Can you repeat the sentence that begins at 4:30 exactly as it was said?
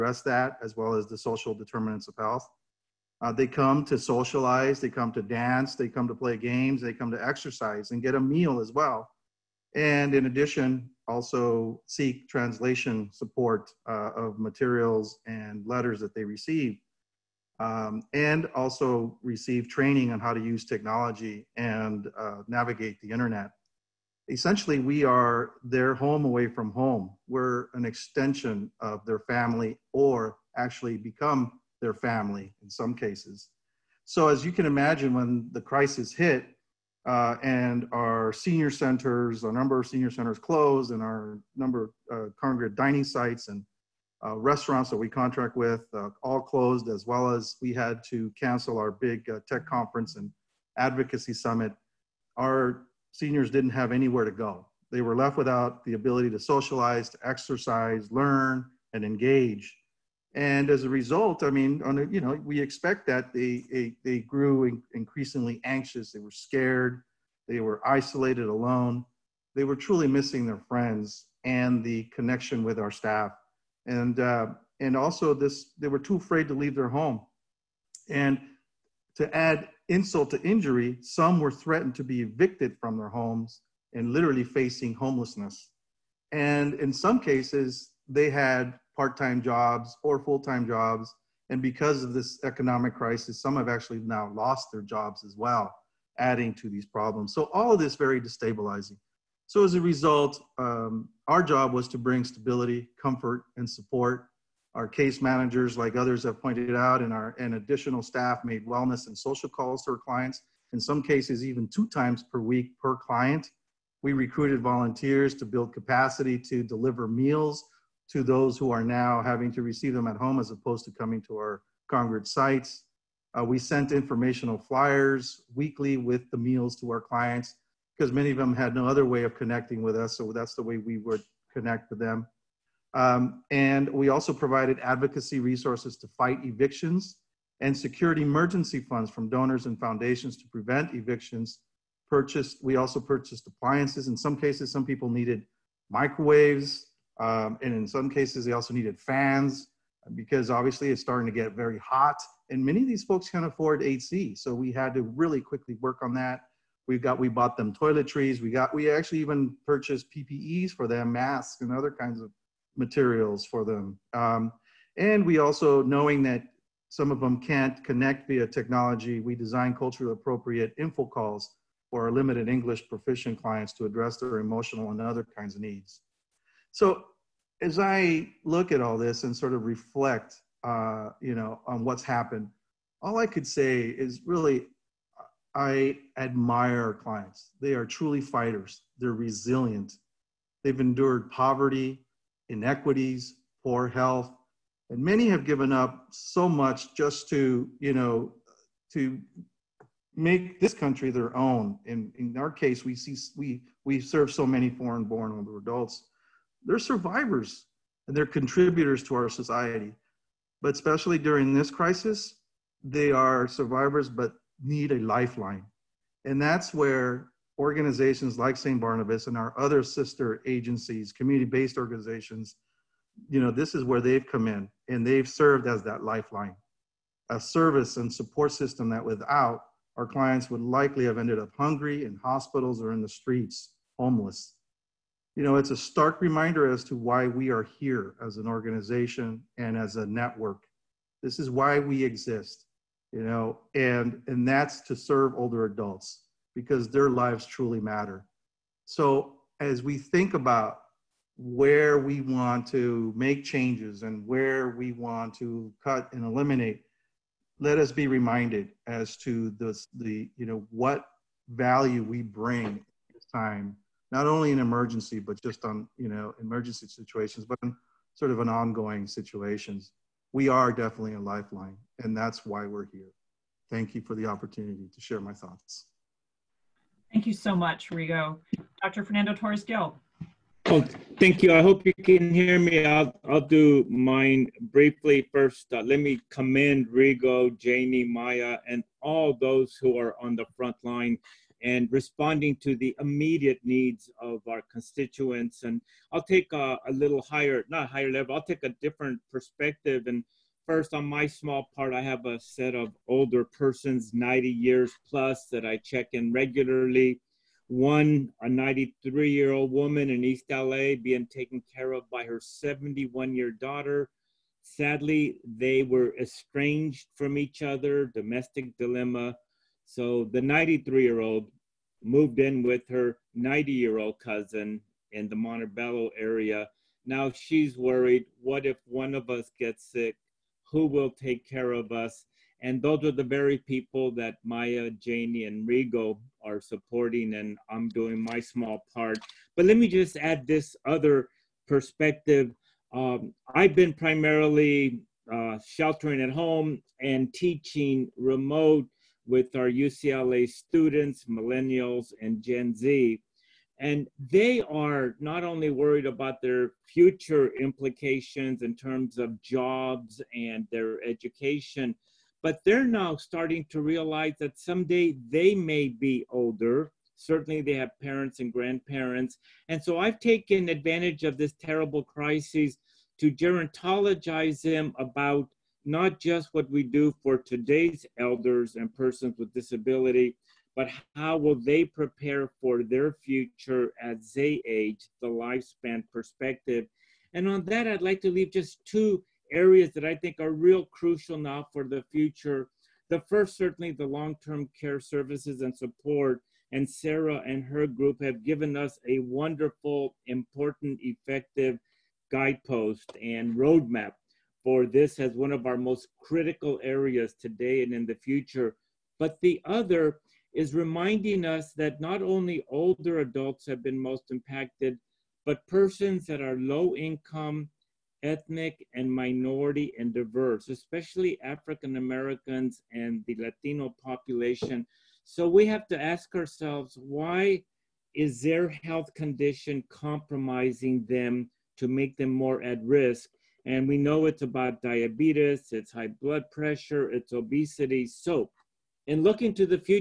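We are definitely a lifeline, and that's why we're here.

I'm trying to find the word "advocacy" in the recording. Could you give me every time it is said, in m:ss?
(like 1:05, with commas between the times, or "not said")
0:50, 2:14.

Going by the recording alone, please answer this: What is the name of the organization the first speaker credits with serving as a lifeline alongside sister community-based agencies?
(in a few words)
St. Barnabas.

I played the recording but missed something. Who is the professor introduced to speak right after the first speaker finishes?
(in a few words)
Fernando Torres-Gil.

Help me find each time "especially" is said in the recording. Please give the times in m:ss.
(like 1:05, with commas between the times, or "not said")
3:30, 7:00.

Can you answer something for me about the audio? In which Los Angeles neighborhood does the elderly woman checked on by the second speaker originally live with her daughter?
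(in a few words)
East LA.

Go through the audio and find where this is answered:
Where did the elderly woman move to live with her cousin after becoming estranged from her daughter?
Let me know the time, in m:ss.
5:25.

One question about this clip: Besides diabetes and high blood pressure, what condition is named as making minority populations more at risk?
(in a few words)
Obesity.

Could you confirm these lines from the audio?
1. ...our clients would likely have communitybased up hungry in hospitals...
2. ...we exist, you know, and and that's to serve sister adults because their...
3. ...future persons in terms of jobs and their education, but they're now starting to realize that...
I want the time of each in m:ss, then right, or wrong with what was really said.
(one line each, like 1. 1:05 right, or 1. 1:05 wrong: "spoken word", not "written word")
1. 3:49 wrong: "ended", not "communitybased"
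2. 4:01 wrong: "older", not "sister"
3. 5:56 wrong: "implications", not "persons".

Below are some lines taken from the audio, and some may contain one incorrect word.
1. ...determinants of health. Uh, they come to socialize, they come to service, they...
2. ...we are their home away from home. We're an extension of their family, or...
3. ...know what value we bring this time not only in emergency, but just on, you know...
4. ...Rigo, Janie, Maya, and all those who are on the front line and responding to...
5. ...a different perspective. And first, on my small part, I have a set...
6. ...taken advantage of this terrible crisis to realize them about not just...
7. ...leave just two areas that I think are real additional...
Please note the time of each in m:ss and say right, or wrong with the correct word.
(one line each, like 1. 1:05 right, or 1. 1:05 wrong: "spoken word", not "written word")
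1. 0:01 wrong: "dance", not "service"
2. 0:24 right
3. 4:20 right
4. 4:46 right
5. 4:58 right
6. 6:10 wrong: "gerontologize", not "realize"
7. 6:28 wrong: "crucial", not "additional".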